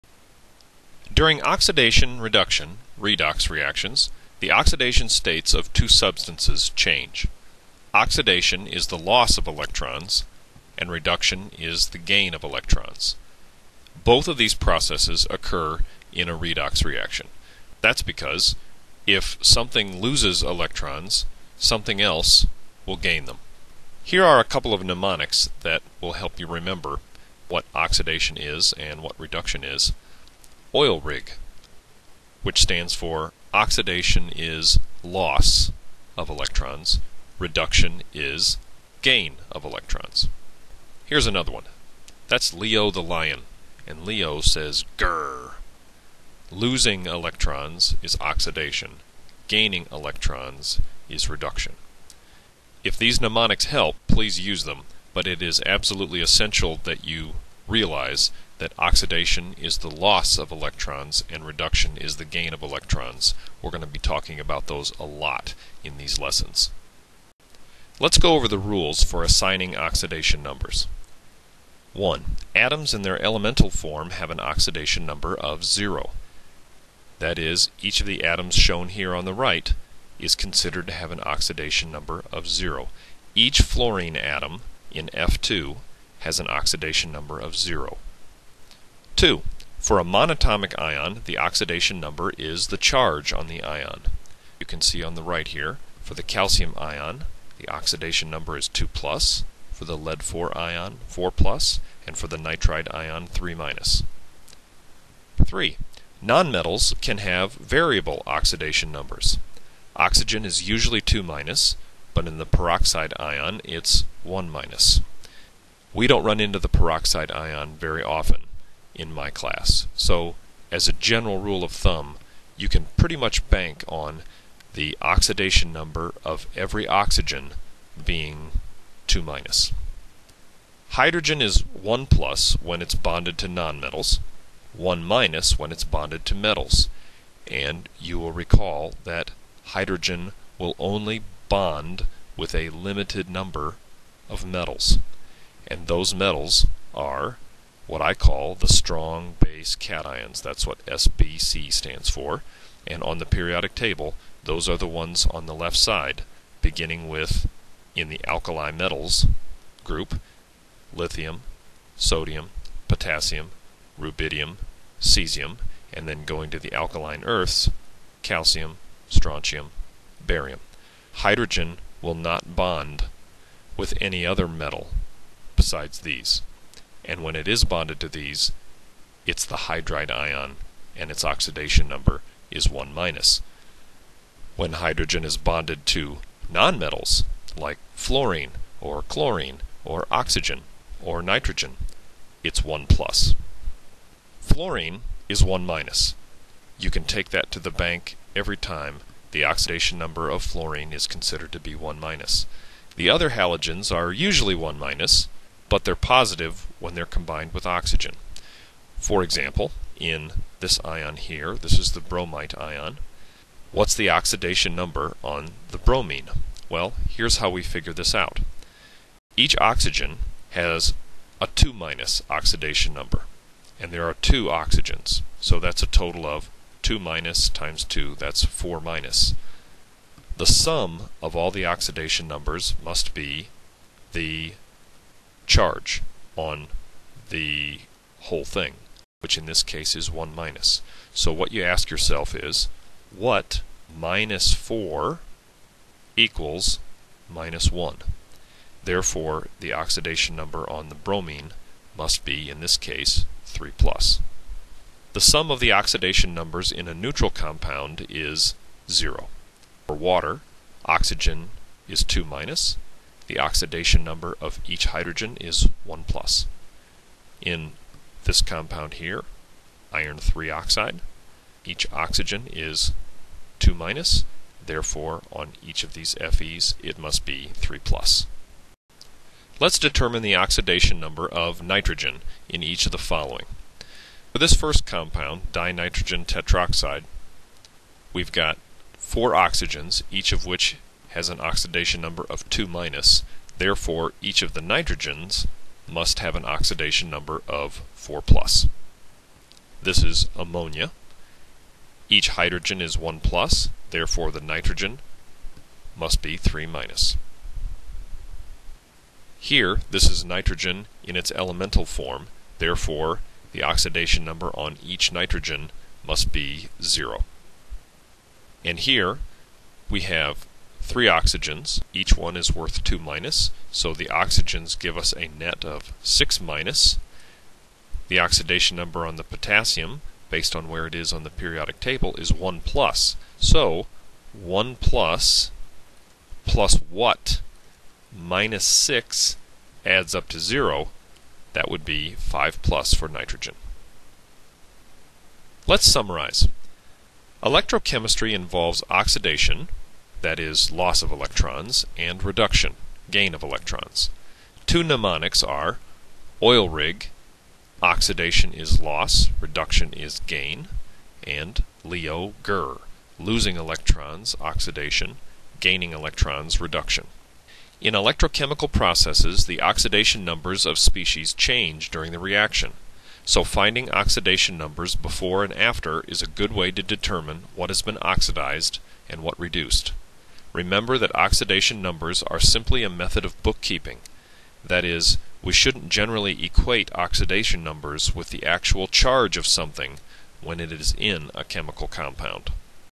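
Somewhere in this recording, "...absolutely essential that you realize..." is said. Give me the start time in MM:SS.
00:55.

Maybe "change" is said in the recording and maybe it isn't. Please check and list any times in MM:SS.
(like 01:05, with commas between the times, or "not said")
00:06, 06:11.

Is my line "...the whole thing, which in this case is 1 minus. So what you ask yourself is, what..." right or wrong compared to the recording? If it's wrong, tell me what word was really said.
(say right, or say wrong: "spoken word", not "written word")
right.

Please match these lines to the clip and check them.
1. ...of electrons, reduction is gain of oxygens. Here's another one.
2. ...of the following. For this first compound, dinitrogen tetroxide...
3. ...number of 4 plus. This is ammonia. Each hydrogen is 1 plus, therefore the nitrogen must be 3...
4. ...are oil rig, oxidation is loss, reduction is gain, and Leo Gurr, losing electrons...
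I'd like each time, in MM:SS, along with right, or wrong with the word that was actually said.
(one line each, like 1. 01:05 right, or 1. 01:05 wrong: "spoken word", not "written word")
1. 00:36 wrong: "electrons", not "oxygens"
2. 04:42 right
3. 04:57 right
4. 05:55 right.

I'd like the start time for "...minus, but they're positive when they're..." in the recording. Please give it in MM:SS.
03:24.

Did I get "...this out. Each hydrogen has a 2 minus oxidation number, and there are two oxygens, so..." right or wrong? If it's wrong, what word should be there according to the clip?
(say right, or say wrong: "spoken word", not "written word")
wrong: "oxygen", not "hydrogen".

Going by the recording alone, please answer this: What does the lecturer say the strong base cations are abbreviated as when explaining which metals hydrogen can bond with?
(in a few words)
SBC.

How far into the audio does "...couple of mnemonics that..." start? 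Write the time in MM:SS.
00:24.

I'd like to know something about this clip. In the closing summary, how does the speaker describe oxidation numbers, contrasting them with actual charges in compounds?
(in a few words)
a method of bookkeeping.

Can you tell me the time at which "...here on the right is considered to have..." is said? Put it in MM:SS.
01:18.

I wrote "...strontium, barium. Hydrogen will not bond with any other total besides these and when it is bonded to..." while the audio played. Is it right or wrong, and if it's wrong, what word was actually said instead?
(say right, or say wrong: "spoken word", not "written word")
wrong: "metal", not "total".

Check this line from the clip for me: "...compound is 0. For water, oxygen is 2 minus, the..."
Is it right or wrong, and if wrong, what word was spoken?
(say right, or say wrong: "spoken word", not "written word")
right.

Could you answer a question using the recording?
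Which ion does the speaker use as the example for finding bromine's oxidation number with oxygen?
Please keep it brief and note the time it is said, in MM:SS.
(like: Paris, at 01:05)
bromite ion, at 03:32.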